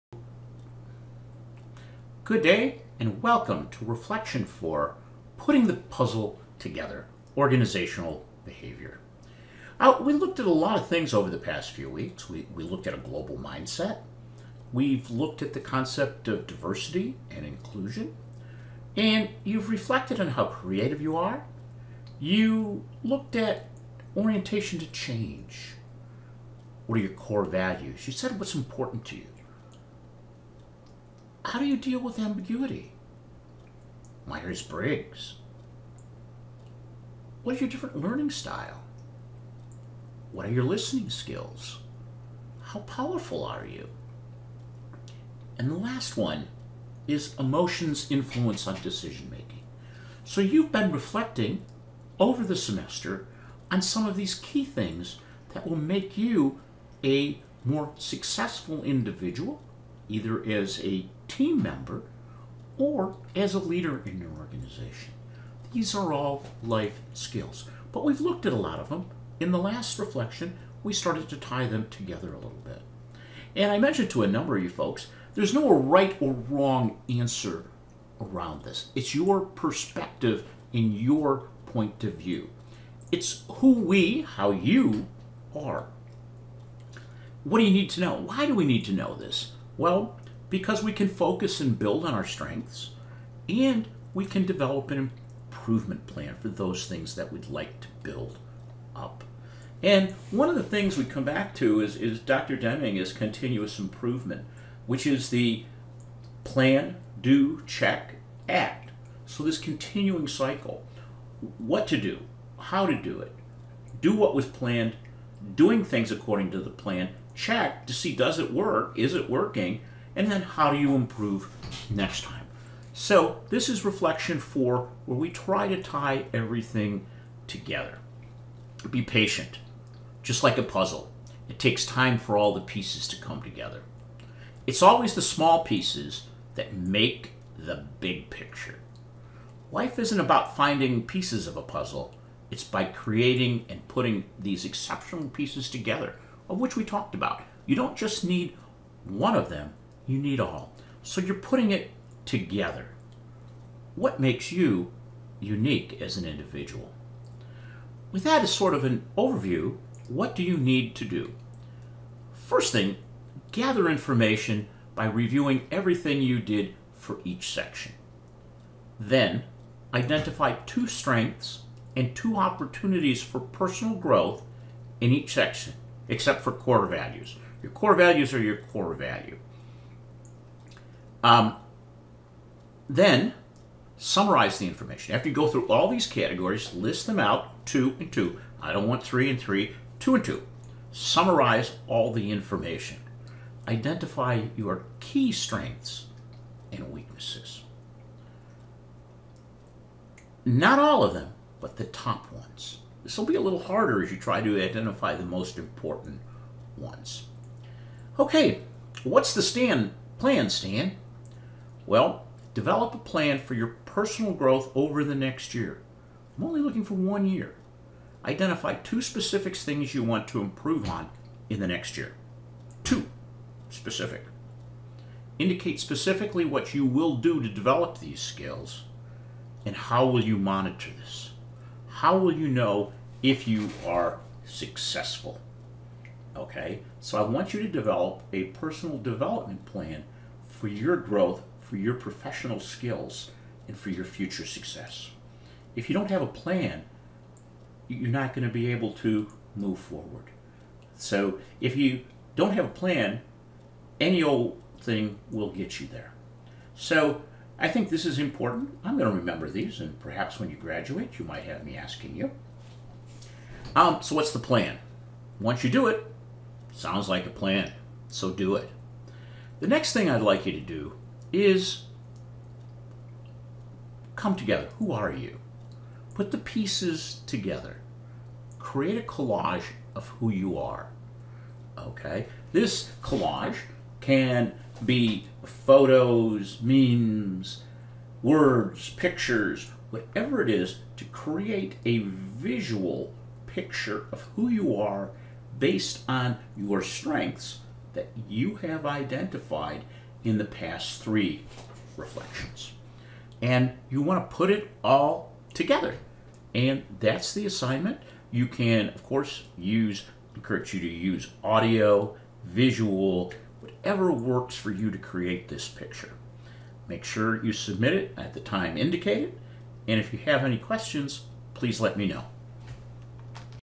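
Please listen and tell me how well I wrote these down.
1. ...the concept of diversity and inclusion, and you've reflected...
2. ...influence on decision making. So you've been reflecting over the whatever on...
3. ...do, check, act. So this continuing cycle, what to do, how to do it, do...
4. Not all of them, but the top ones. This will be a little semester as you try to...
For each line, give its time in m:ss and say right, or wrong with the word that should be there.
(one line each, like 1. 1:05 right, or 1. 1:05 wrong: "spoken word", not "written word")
1. 0:15 right
2. 0:48 wrong: "semester", not "whatever"
3. 1:47 right
4. 3:20 wrong: "harder", not "semester".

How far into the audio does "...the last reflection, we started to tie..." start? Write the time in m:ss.
1:09.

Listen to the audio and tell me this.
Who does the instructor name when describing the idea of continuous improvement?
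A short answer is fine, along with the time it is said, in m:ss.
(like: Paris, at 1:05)
Dr. Deming, at 1:42.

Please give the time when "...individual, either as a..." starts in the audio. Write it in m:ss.
0:58.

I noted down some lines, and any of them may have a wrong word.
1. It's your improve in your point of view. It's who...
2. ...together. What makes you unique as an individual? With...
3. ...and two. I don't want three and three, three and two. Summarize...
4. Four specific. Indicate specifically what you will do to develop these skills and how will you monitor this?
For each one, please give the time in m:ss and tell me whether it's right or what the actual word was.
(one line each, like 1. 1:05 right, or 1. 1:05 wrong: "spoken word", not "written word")
1. 1:18 wrong: "perspective", not "improve"
2. 2:32 right
3. 3:07 wrong: "two", not "three"
4. 3:42 wrong: "Two", not "Four".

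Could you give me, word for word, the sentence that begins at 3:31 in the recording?
Well, develop a plan for your personal growth over the next year.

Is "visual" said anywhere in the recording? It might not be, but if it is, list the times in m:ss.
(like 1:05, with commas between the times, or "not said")
4:51, 5:12.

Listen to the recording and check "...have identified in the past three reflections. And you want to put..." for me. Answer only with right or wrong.
right.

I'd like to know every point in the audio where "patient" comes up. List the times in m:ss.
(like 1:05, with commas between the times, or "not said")
2:09.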